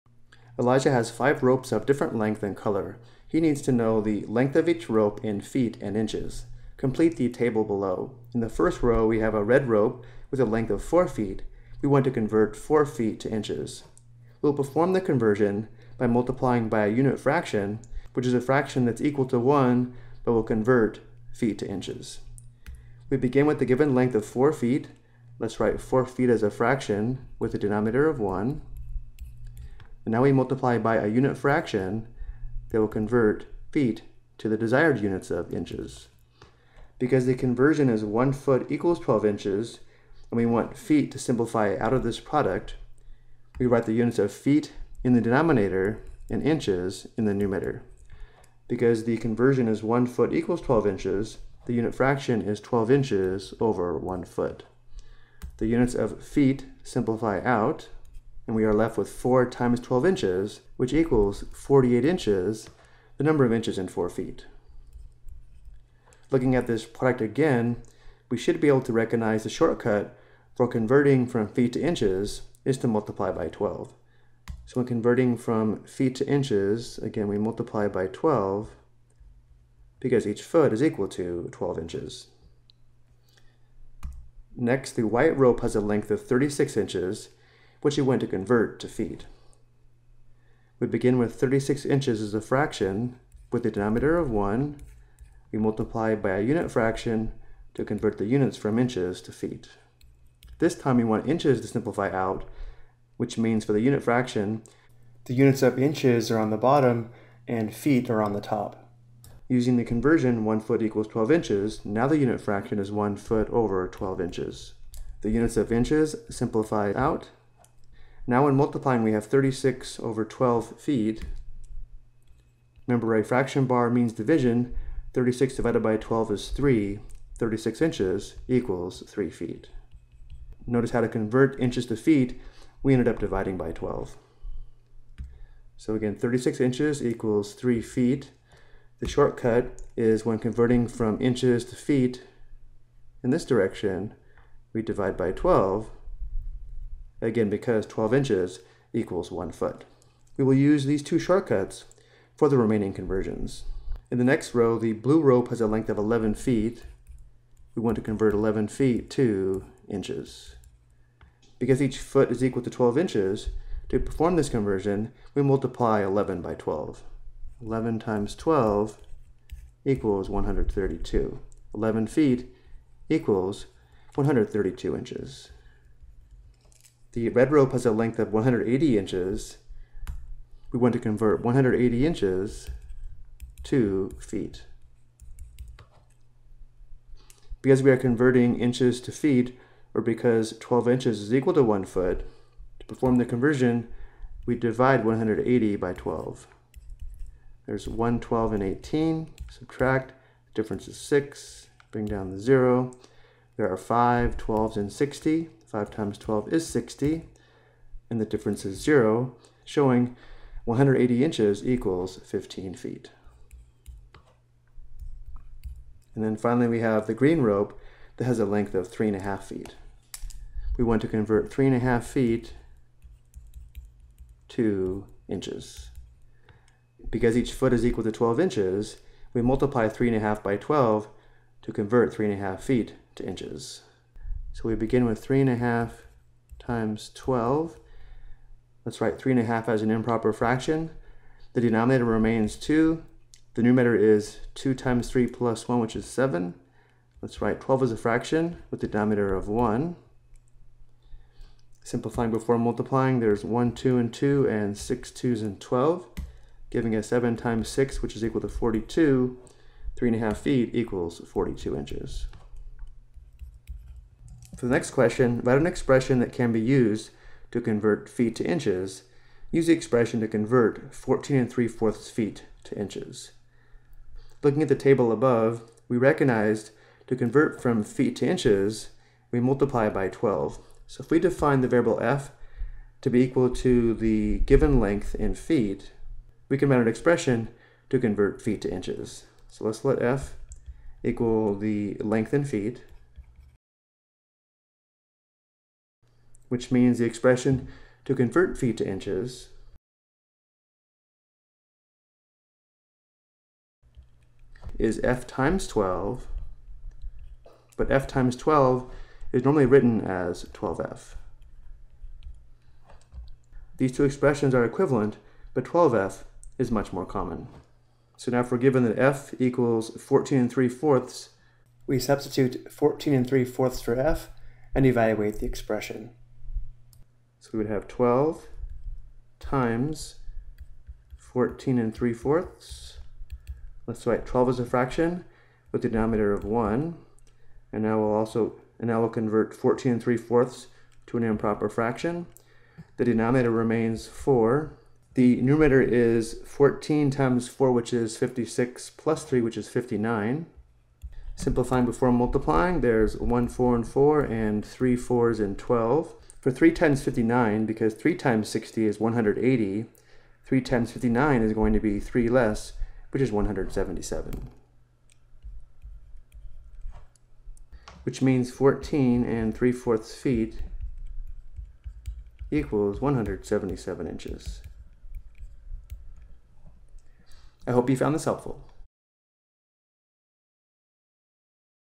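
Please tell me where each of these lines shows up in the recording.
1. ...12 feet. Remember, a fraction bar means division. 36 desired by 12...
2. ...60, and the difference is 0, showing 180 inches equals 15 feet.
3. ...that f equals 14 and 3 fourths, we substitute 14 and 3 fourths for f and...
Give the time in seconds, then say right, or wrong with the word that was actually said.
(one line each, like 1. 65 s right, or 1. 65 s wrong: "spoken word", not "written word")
1. 120 s wrong: "divided", not "desired"
2. 206 s right
3. 318 s right.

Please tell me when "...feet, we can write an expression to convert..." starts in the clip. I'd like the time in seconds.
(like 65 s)
285 s.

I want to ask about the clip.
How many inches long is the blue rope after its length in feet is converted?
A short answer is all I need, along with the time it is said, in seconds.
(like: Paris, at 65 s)
132 inches, at 174 s.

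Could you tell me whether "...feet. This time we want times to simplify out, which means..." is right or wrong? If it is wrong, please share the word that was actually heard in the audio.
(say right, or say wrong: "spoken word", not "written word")
wrong: "inches", not "times".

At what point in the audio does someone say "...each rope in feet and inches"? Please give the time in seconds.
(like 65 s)
4 s.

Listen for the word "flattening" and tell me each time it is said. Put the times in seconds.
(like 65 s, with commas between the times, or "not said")
not said.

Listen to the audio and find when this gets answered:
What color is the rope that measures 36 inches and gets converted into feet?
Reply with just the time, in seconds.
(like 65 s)
85 s.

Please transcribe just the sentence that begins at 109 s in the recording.
Using the conversion 1 foot equals 12 inches, now the unit fraction is 1 foot over 12 inches.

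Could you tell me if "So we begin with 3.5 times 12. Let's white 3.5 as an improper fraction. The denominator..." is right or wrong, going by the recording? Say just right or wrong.
wrong.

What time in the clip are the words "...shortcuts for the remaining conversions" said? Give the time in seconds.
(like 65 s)
151 s.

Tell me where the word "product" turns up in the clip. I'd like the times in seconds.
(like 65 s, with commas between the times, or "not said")
42 s, 66 s.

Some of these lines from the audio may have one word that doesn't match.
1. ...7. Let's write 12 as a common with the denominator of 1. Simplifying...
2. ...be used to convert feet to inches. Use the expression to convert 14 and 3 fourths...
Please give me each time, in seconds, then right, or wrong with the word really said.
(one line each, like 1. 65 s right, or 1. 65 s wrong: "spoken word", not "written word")
1. 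246 s wrong: "fraction", not "common"
2. 266 s right.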